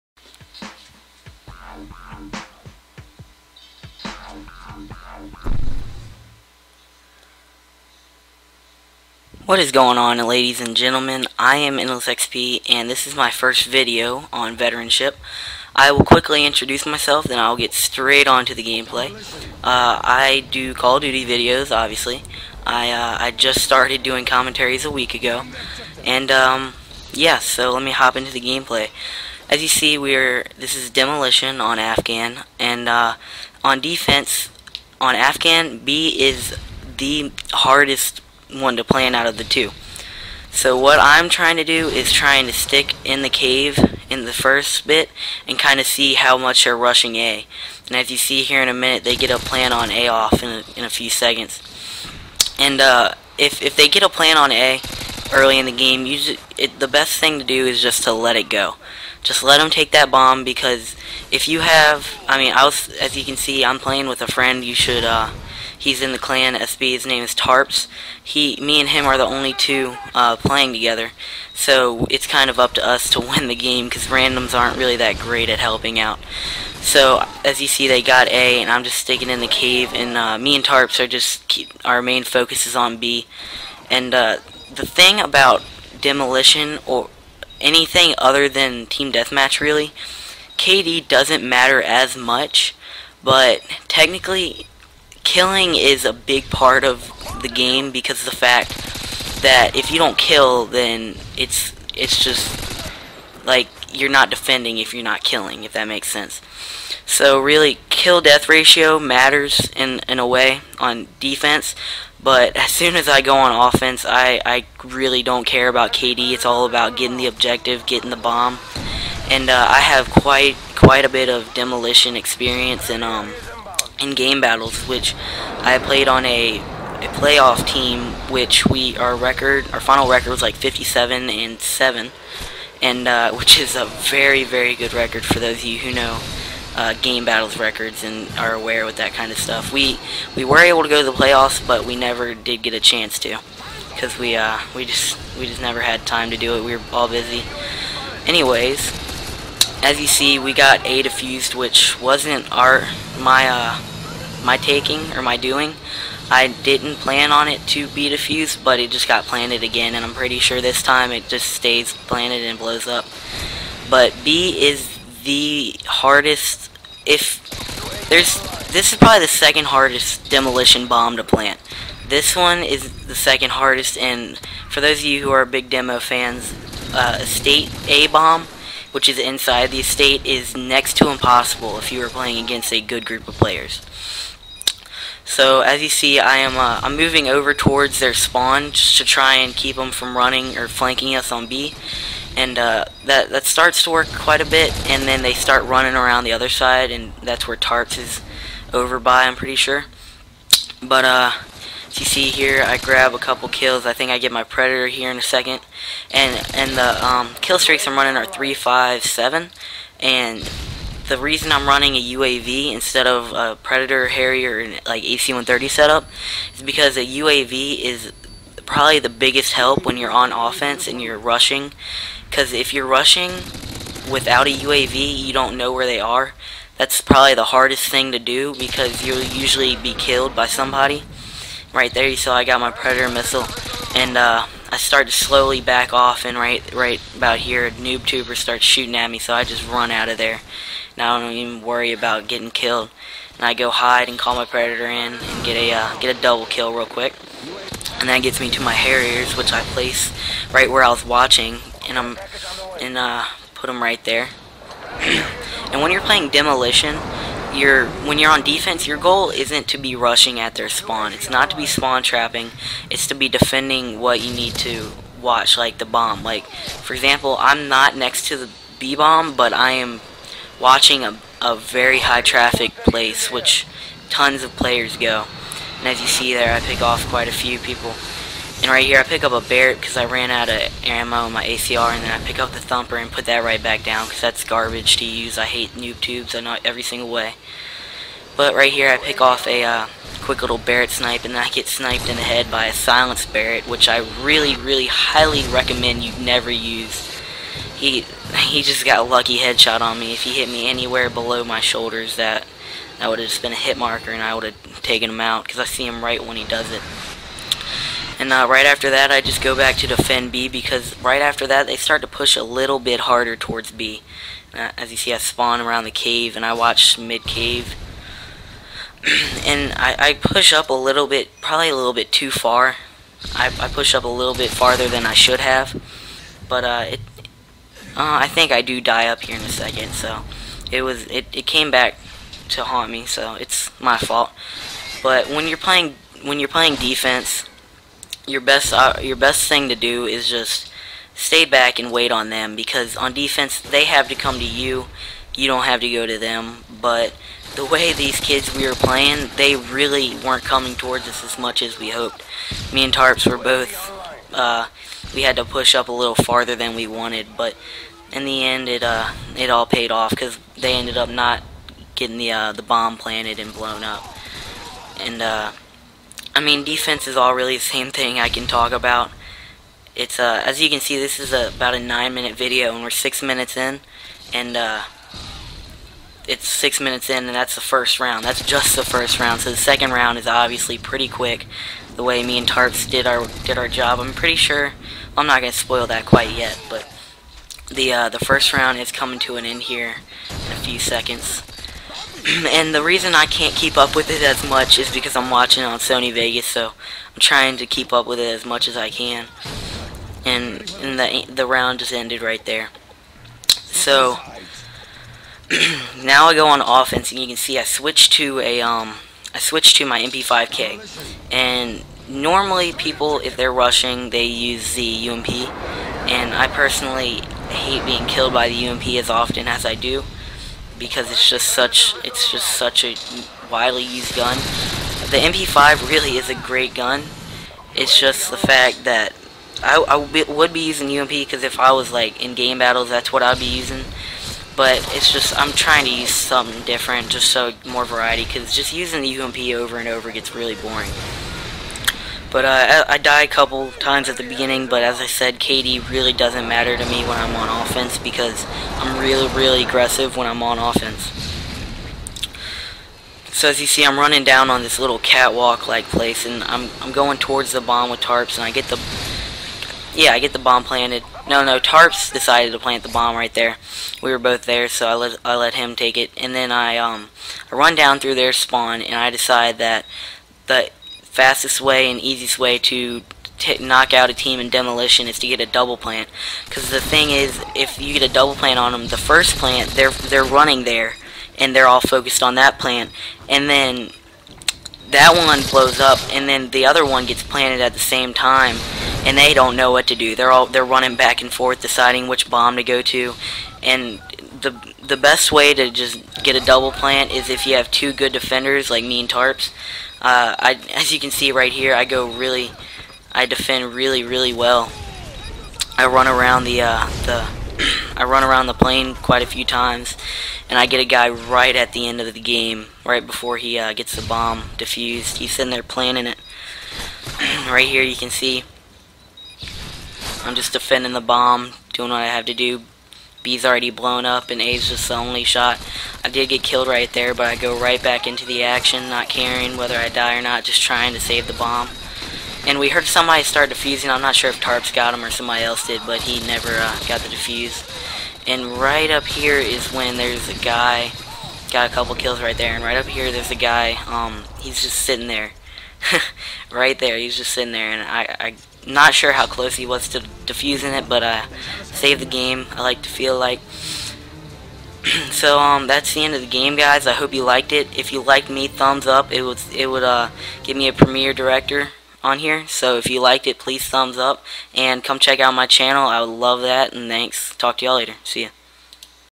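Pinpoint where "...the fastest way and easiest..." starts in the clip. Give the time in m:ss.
7:50.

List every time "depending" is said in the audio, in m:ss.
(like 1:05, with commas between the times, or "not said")
not said.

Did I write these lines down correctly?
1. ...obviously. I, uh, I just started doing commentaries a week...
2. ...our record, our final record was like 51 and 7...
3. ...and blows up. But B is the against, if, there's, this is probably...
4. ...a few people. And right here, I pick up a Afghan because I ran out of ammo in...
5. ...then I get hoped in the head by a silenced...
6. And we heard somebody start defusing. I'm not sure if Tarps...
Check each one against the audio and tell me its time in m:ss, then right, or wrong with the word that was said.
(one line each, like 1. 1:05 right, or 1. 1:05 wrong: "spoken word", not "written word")
1. 0:21 right
2. 2:08 wrong: "57", not "51"
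3. 2:42 wrong: "hardest", not "against"
4. 4:37 wrong: "Barrett", not "Afghan"
5. 4:51 wrong: "sniped", not "hoped"
6. 8:52 right.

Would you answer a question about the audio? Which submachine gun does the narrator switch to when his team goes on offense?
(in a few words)
MP5K.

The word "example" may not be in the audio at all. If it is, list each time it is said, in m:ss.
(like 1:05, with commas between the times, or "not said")
4:26.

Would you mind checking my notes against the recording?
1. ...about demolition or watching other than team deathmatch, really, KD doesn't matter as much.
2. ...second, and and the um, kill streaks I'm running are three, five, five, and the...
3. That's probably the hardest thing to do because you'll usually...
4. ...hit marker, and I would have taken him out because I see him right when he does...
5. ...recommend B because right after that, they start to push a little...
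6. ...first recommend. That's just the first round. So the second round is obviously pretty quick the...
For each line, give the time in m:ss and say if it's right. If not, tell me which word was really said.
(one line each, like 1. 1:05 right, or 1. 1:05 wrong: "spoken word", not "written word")
1. 1:25 wrong: "anything", not "watching"
2. 3:25 wrong: "seven", not "five"
3. 3:46 right
4. 5:03 right
5. 5:09 wrong: "defend", not "recommend"
6. 6:17 wrong: "round", not "recommend".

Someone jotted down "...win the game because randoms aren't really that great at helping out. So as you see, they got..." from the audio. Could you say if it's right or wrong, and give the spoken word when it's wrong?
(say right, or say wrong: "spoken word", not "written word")
right.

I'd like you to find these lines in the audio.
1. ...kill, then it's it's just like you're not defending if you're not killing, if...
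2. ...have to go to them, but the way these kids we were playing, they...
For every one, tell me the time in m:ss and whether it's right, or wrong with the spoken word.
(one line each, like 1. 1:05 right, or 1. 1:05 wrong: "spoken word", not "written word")
1. 1:40 right
2. 5:45 right.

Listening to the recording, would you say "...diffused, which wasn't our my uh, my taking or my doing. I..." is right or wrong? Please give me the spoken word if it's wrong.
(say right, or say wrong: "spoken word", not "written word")
right.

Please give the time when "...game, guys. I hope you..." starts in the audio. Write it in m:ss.
9:16.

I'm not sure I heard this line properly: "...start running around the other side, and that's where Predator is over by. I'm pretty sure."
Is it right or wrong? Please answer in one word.
wrong.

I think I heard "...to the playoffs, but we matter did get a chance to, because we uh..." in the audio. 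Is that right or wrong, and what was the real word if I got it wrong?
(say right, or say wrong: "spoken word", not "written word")
wrong: "never", not "matter".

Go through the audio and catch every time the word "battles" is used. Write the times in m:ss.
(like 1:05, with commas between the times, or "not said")
2:04, 2:17, 7:12.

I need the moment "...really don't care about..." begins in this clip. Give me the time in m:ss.
1:54.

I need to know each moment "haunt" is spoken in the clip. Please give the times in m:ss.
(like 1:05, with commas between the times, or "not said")
5:32.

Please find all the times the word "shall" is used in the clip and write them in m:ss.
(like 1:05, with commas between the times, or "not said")
not said.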